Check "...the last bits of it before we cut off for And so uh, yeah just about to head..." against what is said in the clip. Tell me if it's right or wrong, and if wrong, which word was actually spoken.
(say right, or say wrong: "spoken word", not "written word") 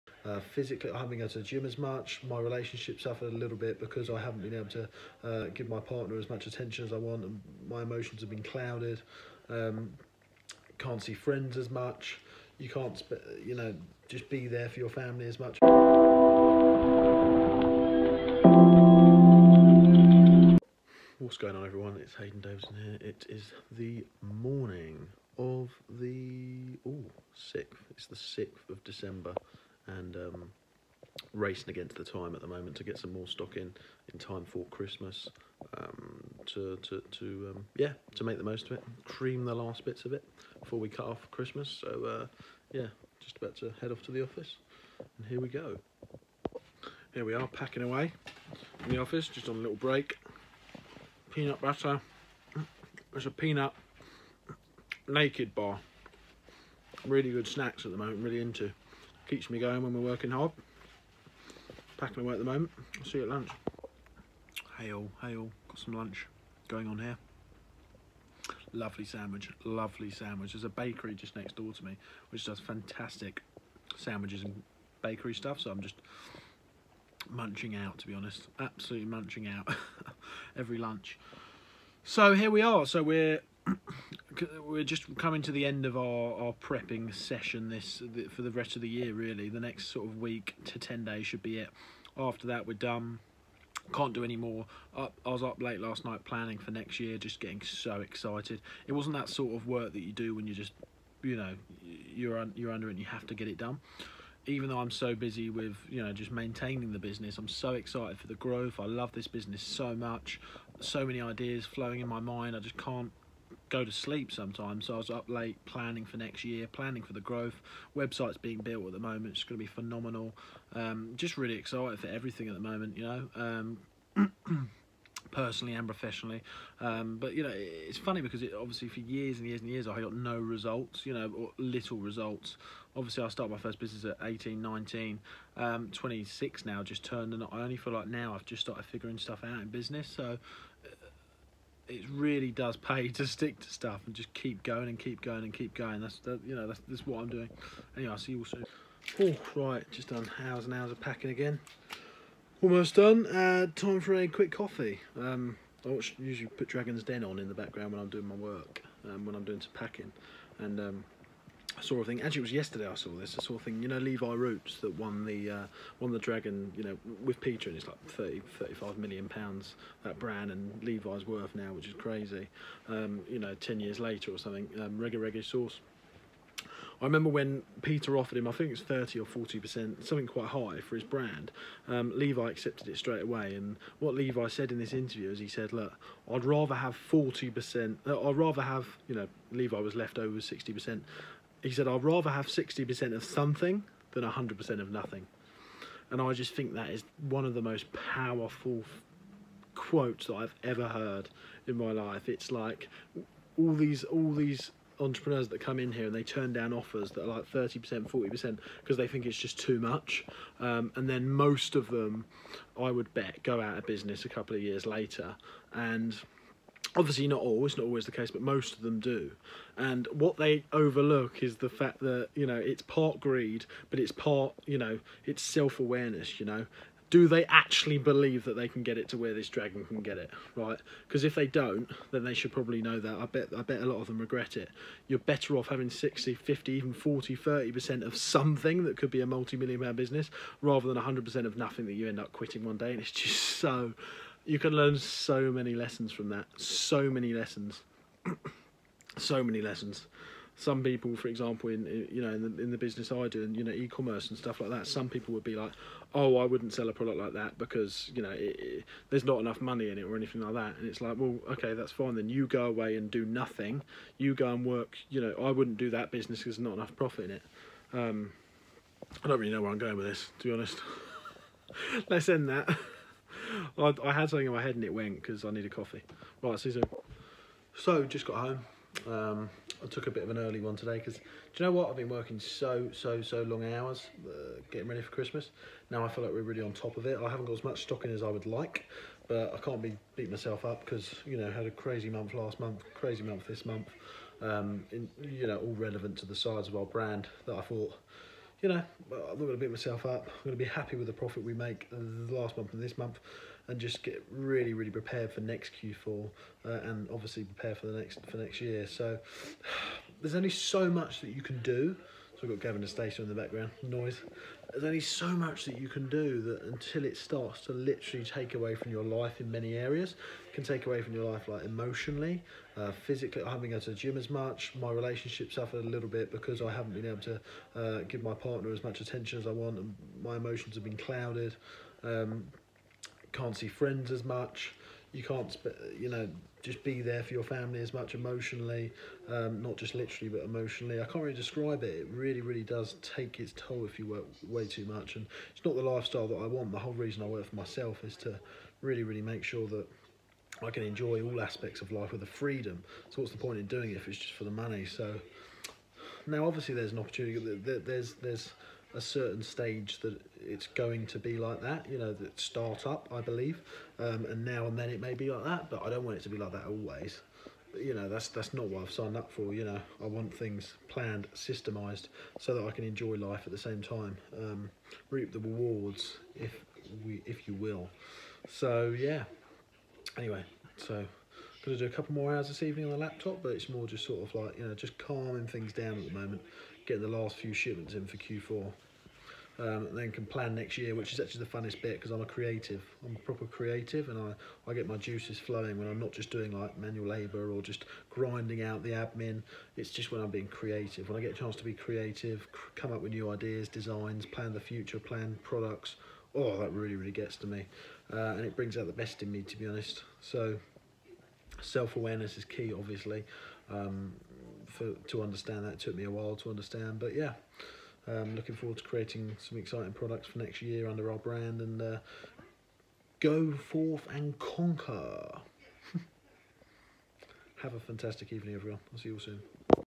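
wrong: "Christmas", not "And".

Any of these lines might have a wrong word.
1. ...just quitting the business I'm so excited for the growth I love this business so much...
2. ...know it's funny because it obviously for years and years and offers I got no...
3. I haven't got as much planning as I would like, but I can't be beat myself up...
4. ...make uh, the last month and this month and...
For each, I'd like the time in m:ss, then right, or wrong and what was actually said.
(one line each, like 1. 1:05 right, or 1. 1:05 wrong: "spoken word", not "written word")
1. 1:46 wrong: "maintaining", not "quitting"
2. 2:07 wrong: "years", not "offers"
3. 4:47 wrong: "stocking", not "planning"
4. 5:01 right.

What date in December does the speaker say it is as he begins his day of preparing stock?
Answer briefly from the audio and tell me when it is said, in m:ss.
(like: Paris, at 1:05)
6th, at 0:28.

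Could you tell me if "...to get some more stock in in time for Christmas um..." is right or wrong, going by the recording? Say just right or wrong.
right.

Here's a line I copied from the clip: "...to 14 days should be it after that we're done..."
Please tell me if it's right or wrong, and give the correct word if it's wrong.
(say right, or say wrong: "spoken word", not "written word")
wrong: "10", not "14".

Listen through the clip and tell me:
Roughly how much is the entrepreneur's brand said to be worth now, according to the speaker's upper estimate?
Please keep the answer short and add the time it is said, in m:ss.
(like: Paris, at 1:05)
35 million pounds, at 2:48.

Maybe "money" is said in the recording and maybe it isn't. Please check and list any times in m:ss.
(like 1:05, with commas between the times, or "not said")
4:19, 5:54.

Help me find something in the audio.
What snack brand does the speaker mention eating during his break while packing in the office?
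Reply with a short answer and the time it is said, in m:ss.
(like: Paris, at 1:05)
Naked, at 0:55.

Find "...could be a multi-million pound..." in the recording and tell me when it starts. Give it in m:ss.
3:58.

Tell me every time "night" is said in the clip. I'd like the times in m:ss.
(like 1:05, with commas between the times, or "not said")
1:36.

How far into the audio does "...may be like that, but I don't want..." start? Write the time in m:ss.
6:04.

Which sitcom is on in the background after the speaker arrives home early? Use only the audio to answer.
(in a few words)
Gavin and Stacey.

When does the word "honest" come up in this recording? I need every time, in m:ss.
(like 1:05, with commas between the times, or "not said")
1:18, 4:30, 6:49.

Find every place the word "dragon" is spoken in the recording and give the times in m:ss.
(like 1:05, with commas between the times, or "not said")
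2:36, 2:46, 3:49.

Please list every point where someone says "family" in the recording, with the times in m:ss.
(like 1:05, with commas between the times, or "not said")
0:14, 5:37.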